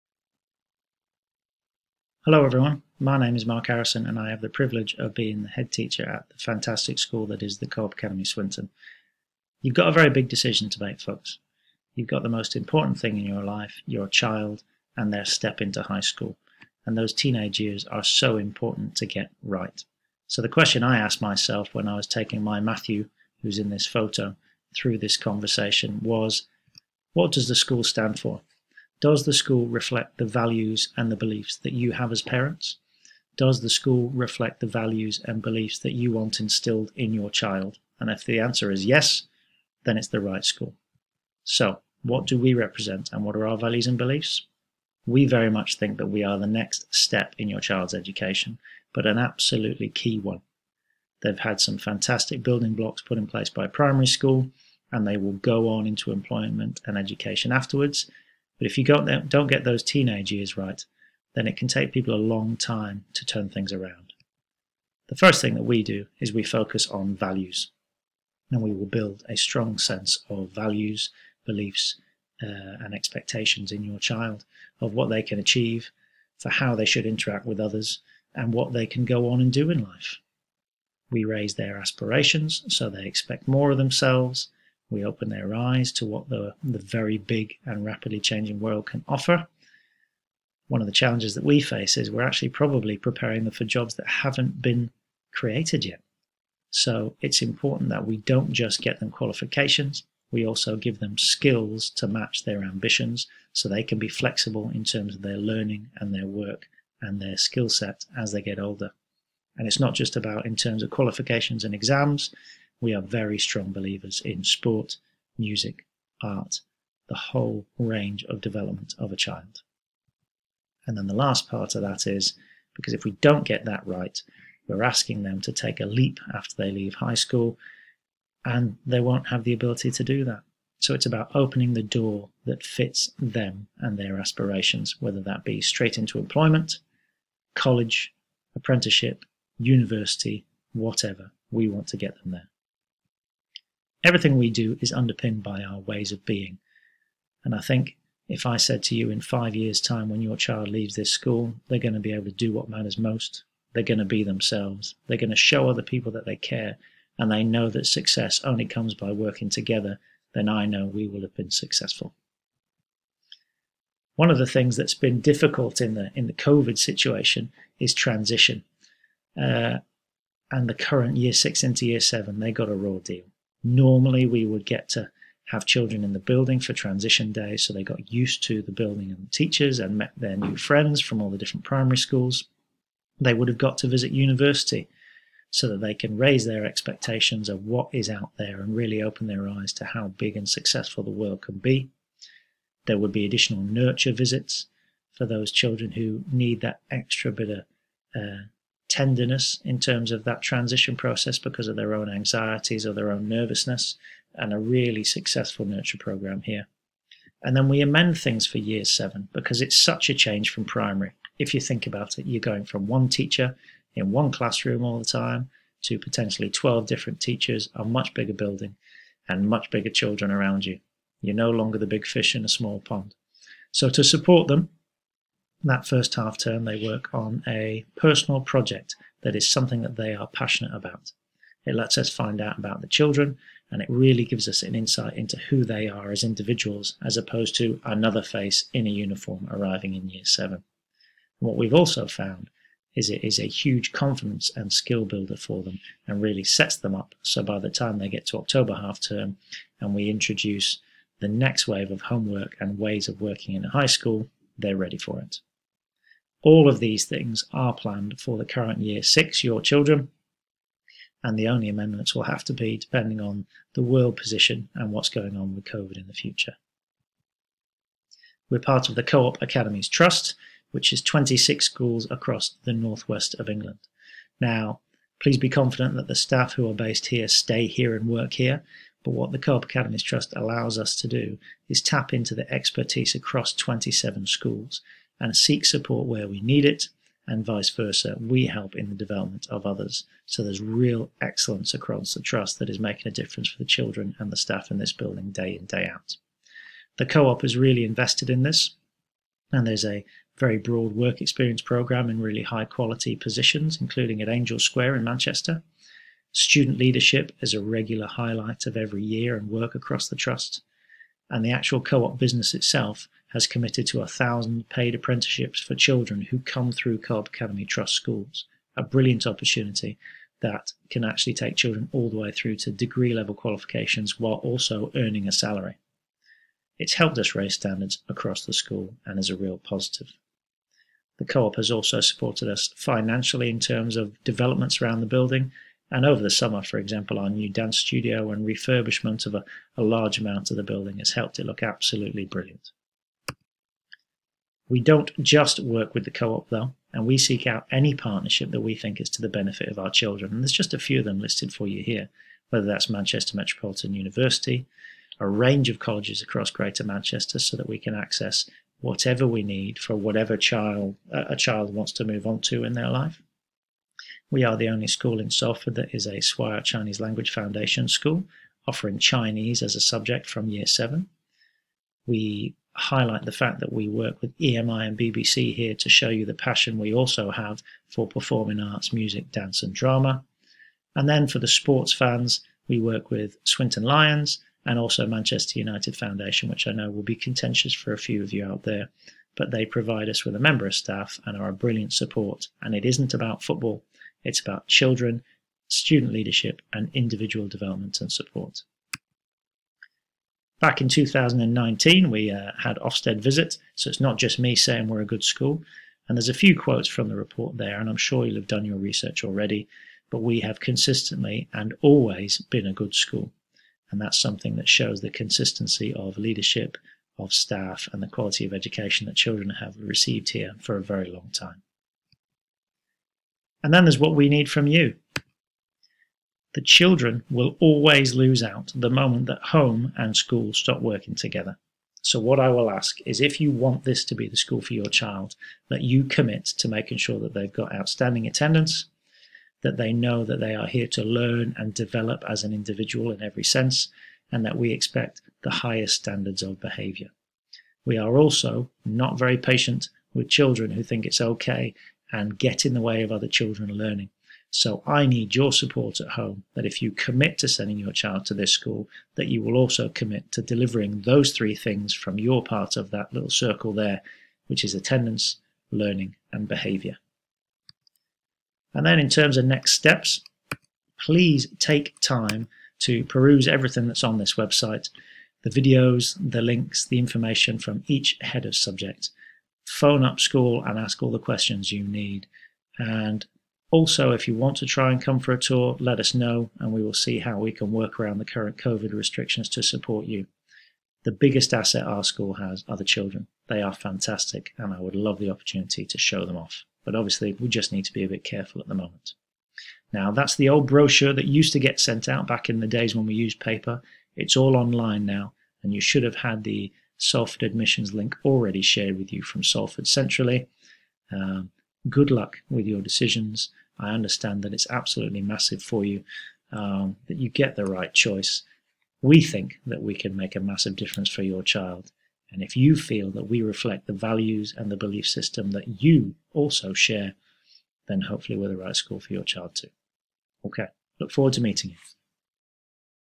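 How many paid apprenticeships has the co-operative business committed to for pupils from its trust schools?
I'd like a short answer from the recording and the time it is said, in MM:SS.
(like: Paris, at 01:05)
1000, at 05:14.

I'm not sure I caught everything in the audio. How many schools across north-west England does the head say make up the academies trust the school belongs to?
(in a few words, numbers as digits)
26.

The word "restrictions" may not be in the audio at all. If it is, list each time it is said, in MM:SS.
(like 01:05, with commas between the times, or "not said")
08:08.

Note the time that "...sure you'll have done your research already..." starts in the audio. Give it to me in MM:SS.
06:47.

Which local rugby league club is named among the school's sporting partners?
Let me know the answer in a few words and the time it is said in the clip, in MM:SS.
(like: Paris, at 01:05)
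Swinton Lions, at 06:23.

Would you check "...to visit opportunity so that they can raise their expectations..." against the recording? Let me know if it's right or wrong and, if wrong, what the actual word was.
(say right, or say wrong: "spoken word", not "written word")
wrong: "university", not "opportunity".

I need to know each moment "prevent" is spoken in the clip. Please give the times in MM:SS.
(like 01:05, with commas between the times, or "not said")
not said.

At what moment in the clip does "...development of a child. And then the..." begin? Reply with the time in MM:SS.
01:58.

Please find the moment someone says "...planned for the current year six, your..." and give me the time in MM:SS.
04:17.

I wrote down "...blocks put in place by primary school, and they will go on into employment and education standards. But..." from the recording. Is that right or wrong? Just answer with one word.
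wrong.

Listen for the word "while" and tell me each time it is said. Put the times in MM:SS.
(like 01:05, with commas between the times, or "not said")
05:24.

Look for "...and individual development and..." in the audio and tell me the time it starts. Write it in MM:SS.
06:36.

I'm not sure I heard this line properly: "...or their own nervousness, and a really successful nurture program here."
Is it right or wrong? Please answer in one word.
right.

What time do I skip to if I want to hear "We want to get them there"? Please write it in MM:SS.
02:21.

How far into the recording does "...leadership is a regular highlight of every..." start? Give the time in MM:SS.
05:06.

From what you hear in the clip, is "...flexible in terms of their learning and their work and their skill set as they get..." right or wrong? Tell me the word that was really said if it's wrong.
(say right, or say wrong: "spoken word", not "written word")
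right.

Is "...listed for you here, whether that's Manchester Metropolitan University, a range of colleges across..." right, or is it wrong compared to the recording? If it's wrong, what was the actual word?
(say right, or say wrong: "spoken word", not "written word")
right.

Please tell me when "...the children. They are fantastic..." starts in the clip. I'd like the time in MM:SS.
08:12.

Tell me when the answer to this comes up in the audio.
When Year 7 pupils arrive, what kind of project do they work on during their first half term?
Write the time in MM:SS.
03:47.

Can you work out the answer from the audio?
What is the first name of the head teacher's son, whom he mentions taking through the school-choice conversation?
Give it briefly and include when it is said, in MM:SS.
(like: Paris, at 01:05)
Matthew, at 00:22.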